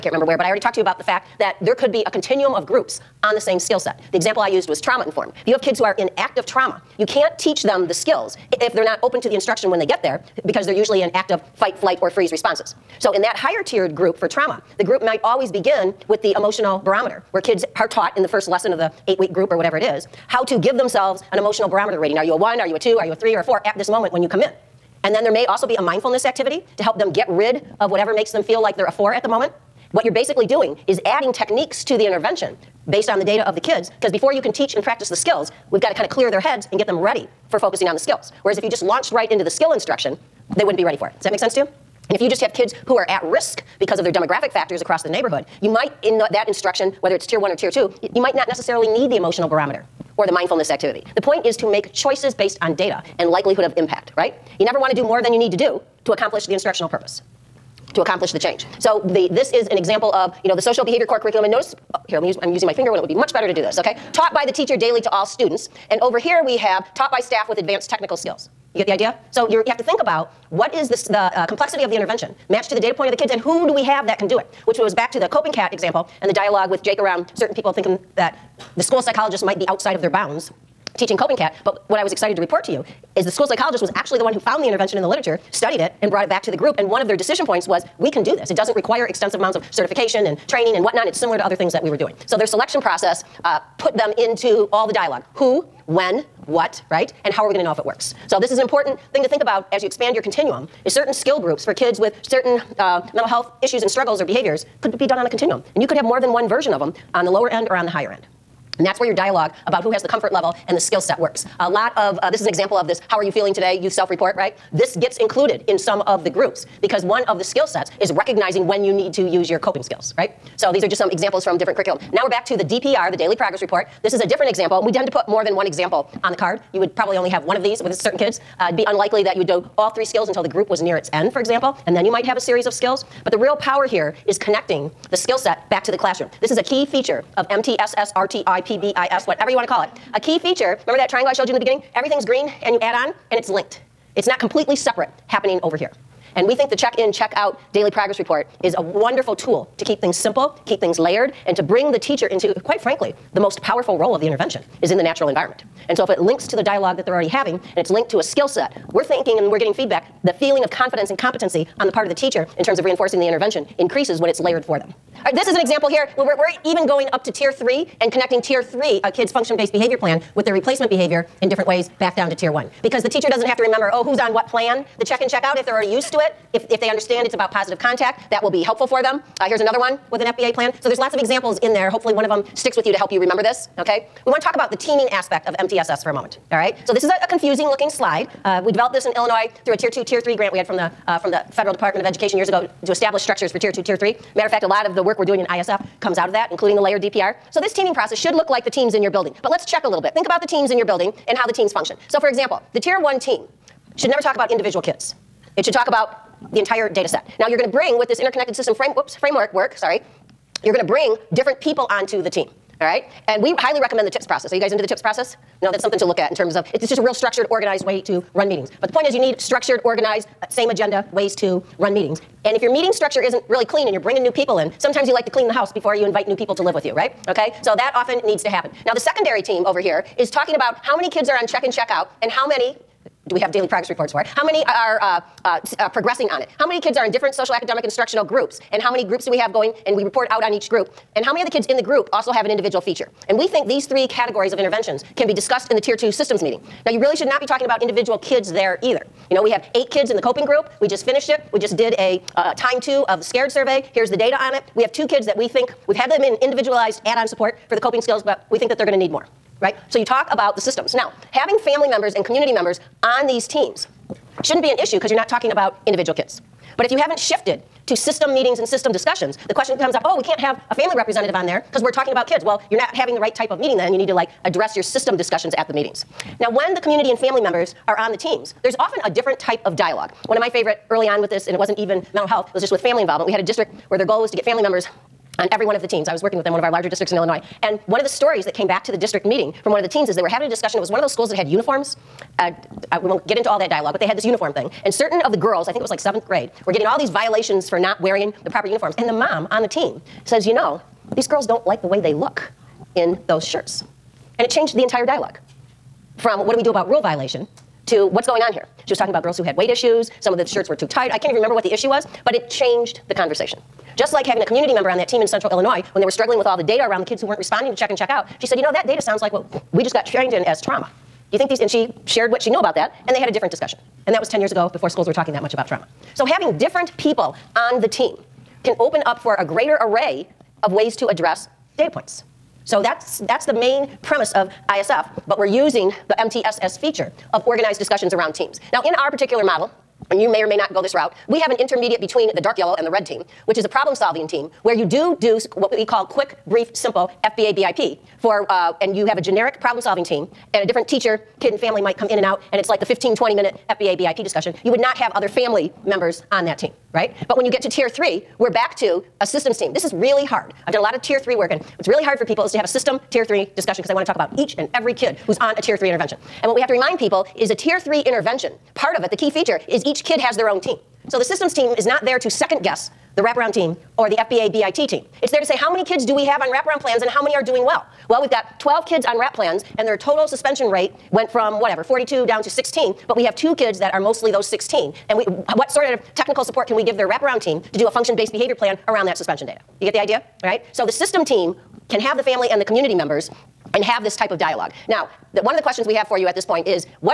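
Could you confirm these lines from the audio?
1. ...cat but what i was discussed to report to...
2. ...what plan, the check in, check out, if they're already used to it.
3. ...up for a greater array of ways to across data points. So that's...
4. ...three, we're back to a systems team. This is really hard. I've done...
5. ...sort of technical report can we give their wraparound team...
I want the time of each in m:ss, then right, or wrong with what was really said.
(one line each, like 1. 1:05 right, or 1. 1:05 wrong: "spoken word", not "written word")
1. 1:21 wrong: "excited", not "discussed"
2. 2:54 right
3. 5:29 wrong: "address", not "across"
4. 5:57 right
5. 6:25 wrong: "support", not "report".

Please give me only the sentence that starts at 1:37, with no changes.
And how are we going to know if it works?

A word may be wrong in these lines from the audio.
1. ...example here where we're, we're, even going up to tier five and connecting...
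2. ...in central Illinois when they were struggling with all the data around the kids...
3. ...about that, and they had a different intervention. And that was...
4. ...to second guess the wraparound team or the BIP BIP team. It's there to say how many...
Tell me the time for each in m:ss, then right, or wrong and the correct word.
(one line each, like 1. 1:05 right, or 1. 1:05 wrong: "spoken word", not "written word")
1. 2:45 wrong: "three", not "five"
2. 5:15 right
3. 5:22 wrong: "discussion", not "intervention"
4. 6:12 wrong: "FBA", not "BIP".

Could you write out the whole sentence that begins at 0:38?
Whereas if you just launched right into the skill instruction, they wouldn't be ready for it.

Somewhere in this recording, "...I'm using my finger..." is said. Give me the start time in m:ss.
1:02.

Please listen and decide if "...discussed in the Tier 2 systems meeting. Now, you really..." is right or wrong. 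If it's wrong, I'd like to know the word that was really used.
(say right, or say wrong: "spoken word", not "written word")
right.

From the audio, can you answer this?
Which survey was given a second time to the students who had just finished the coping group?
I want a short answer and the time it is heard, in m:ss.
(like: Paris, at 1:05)
SCARED survey, at 4:13.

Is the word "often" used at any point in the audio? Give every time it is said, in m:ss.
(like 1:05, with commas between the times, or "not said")
3:47, 4:38.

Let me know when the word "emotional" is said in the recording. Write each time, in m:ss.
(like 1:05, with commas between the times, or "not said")
0:16, 0:21, 0:49.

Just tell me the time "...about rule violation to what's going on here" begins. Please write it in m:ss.
5:06.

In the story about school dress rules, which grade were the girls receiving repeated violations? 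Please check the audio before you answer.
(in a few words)
seventh grade.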